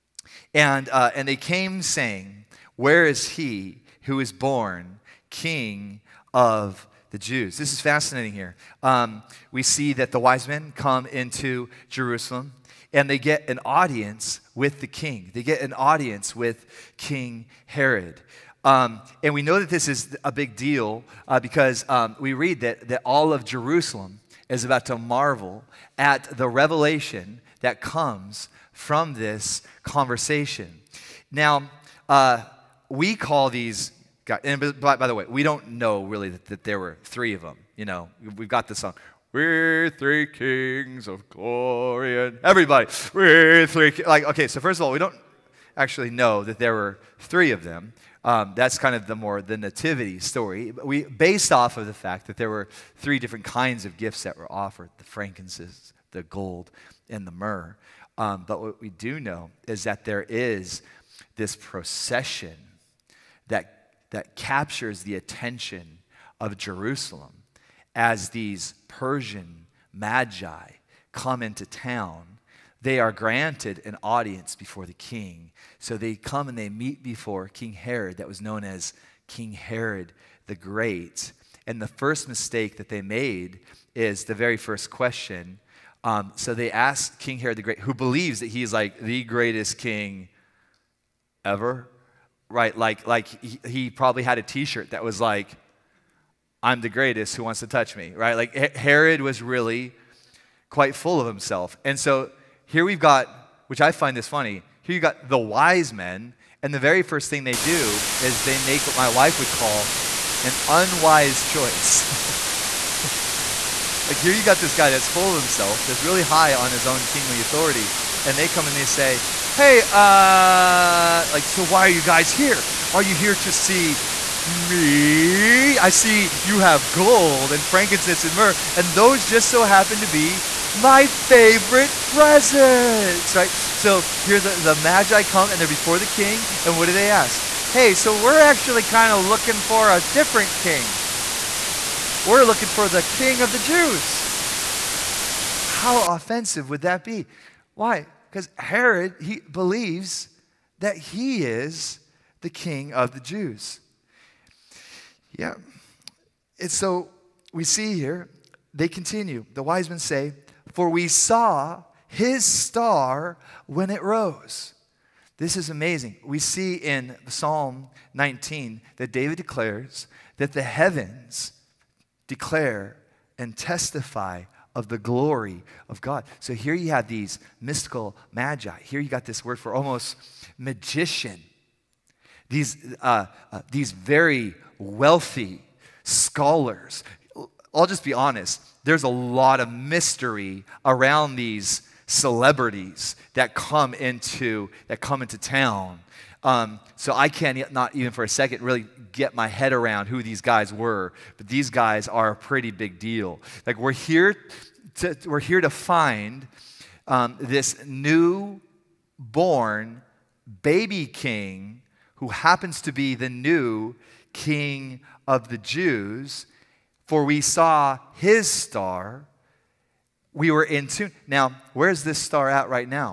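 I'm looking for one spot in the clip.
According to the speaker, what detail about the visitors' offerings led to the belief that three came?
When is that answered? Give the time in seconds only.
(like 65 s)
52 s.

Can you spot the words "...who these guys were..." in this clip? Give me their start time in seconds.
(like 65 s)
200 s.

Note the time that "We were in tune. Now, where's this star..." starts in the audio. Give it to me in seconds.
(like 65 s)
220 s.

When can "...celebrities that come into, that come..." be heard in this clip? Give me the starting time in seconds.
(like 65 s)
192 s.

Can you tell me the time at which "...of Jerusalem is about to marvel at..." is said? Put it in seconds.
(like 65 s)
23 s.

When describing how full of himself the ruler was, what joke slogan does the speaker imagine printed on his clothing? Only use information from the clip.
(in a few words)
I'm the greatest.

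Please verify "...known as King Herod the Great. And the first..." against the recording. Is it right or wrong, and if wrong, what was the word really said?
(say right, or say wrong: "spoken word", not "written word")
right.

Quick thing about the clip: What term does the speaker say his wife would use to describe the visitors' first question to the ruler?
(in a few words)
unwise choice.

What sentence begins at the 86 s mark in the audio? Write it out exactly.
Um, so they asked King Herod the Great, who believes that he's like the greatest king ever, right?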